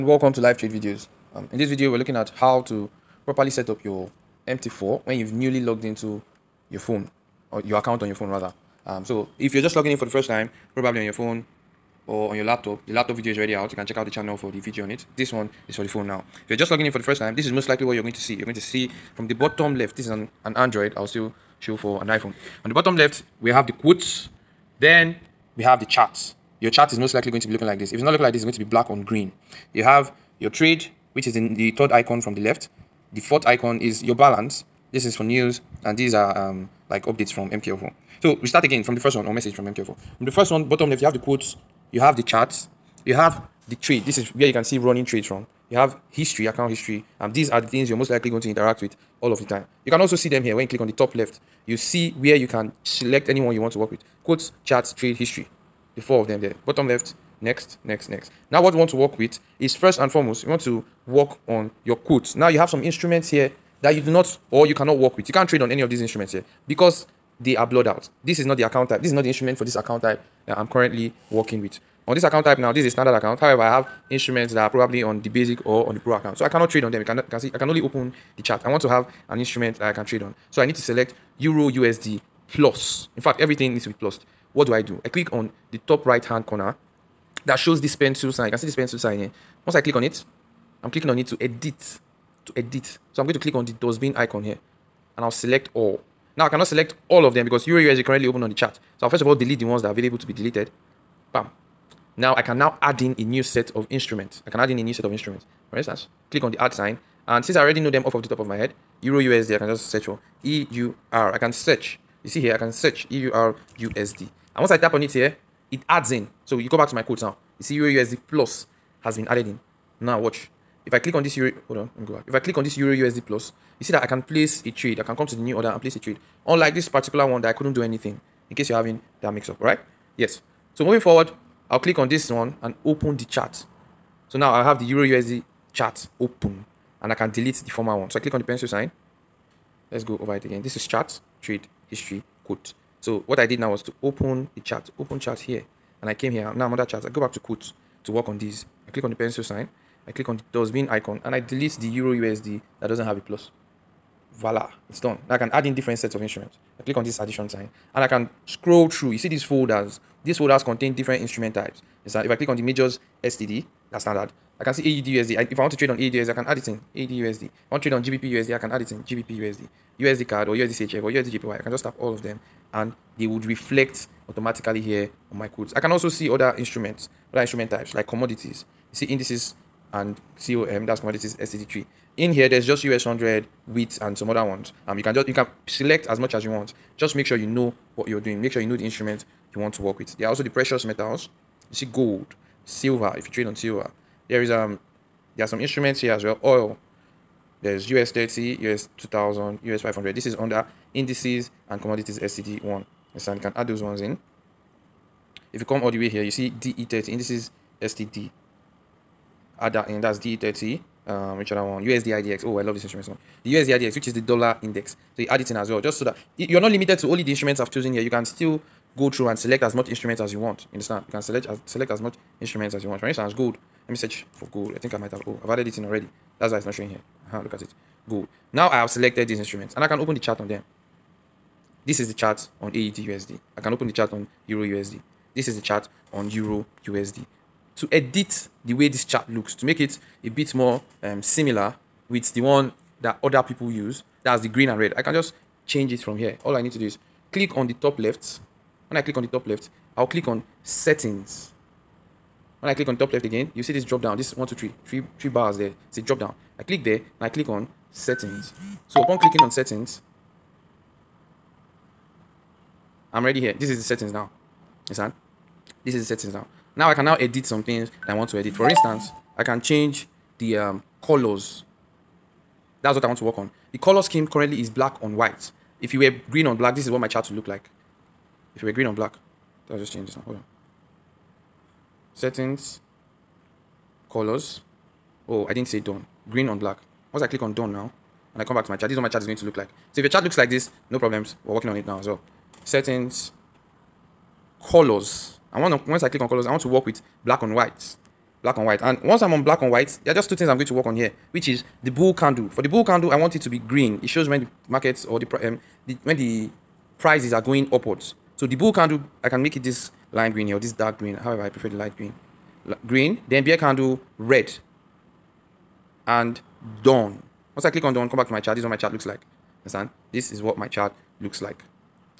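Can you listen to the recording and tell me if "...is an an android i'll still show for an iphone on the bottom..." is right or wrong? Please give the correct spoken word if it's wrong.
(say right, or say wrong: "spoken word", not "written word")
right.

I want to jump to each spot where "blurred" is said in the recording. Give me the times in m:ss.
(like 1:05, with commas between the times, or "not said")
1:07.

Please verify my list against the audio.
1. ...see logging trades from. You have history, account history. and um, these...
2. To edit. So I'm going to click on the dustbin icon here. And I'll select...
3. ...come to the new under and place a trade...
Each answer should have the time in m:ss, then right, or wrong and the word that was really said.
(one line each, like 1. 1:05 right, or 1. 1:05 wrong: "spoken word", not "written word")
1. 0:44 wrong: "running", not "logging"
2. 1:32 right
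3. 2:05 wrong: "order", not "under".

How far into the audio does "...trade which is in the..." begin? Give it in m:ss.
0:30.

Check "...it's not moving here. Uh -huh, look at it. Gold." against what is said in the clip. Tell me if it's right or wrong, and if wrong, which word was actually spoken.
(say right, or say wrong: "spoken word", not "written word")
wrong: "showing", not "moving".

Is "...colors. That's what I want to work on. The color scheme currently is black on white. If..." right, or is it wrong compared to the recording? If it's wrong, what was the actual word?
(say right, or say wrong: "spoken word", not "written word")
right.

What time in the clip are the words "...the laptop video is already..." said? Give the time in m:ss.
0:12.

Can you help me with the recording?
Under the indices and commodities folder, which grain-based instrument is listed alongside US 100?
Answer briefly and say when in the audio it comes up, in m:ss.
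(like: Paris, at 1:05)
wheat, at 3:03.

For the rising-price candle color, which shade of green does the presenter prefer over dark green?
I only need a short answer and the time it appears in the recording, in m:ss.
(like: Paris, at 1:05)
light green, at 5:11.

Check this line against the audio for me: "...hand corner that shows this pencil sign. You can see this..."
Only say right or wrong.
right.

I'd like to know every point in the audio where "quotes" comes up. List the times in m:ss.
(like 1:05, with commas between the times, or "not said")
0:23, 0:41, 0:54, 1:01, 1:57, 2:22, 2:27, 2:55.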